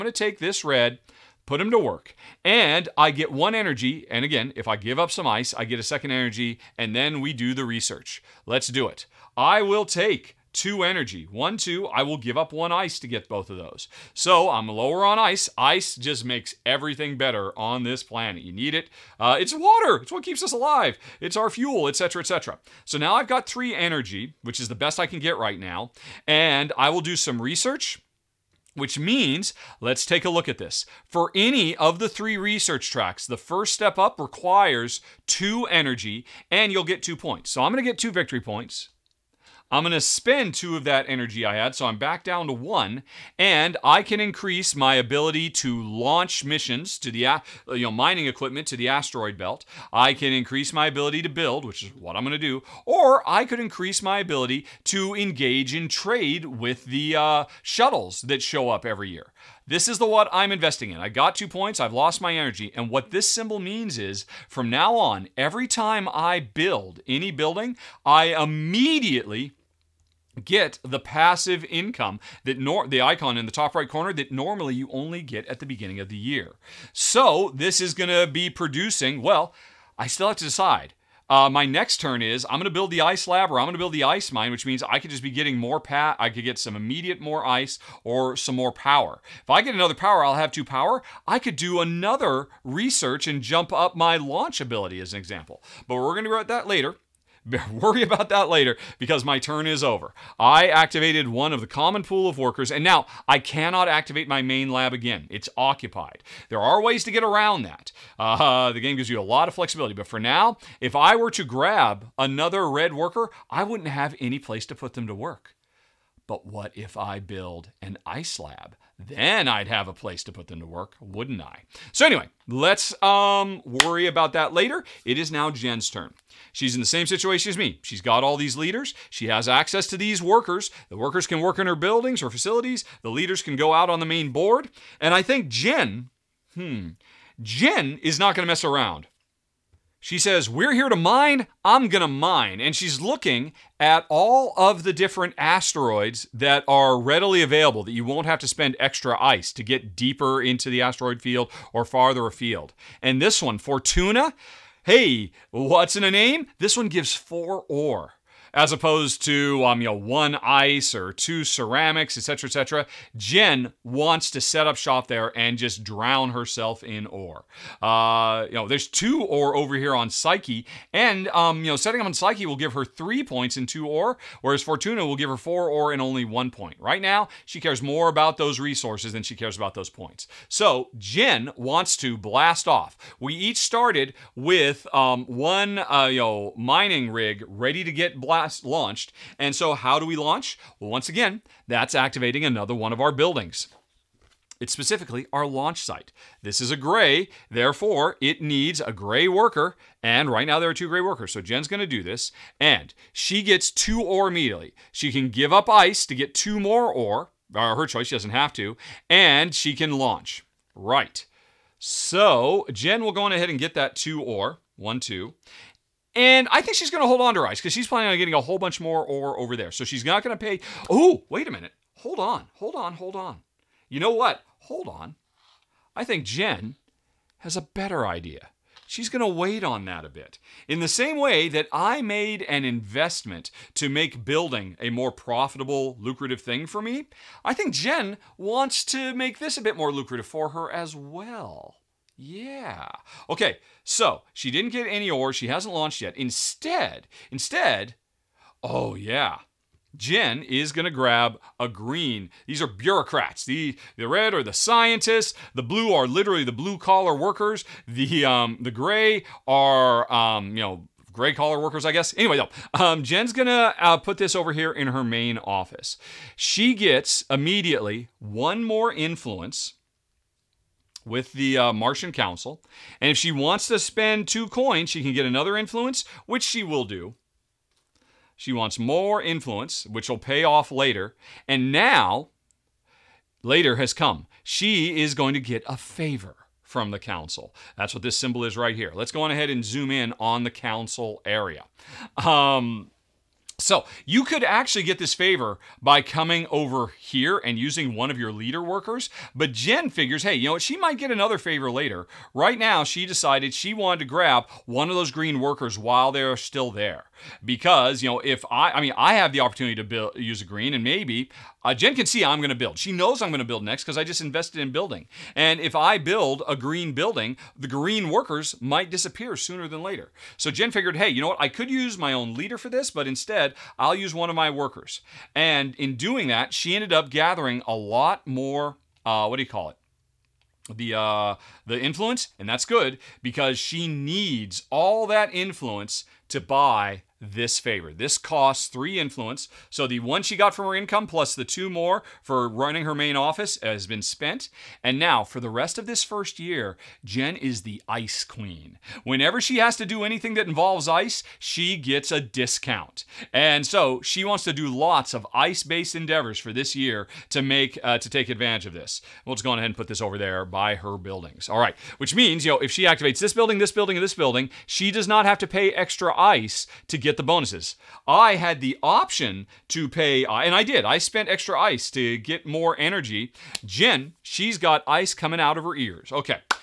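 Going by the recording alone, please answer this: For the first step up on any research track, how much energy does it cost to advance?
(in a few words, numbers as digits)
2 energy.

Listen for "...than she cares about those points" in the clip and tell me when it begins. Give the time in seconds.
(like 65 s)
179 s.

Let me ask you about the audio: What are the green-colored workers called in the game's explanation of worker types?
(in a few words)
bureaucrats.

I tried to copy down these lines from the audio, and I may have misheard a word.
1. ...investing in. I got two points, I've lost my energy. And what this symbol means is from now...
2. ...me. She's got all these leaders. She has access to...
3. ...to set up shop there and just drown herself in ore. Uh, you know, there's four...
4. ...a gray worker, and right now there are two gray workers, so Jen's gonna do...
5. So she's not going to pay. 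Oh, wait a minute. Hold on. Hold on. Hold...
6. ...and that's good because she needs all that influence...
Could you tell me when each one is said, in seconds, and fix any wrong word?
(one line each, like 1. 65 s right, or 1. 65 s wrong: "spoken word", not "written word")
1. 60 s right
2. 127 s right
3. 164 s wrong: "two", not "four"
4. 198 s right
5. 219 s right
6. 332 s right.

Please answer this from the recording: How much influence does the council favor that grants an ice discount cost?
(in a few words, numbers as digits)
3 influence.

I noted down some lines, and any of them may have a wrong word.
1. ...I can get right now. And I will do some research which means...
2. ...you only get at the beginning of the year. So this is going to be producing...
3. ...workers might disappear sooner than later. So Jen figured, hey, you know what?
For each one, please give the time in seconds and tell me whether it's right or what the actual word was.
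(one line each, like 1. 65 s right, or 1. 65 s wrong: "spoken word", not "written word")
1. 24 s right
2. 74 s right
3. 318 s right.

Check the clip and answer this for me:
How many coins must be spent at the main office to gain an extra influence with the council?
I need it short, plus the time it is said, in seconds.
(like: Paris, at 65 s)
2, at 274 s.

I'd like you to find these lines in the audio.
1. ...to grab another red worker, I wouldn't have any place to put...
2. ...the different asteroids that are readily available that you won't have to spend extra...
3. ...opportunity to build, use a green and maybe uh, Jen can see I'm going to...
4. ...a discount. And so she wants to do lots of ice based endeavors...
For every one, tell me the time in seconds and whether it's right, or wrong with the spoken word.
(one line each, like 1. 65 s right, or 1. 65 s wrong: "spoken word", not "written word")
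1. 111 s right
2. 144 s right
3. 309 s right
4. 352 s right.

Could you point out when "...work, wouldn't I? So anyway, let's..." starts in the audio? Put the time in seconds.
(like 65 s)
120 s.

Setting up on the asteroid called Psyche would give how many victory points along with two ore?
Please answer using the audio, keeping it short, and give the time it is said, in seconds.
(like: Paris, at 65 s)
3, at 172 s.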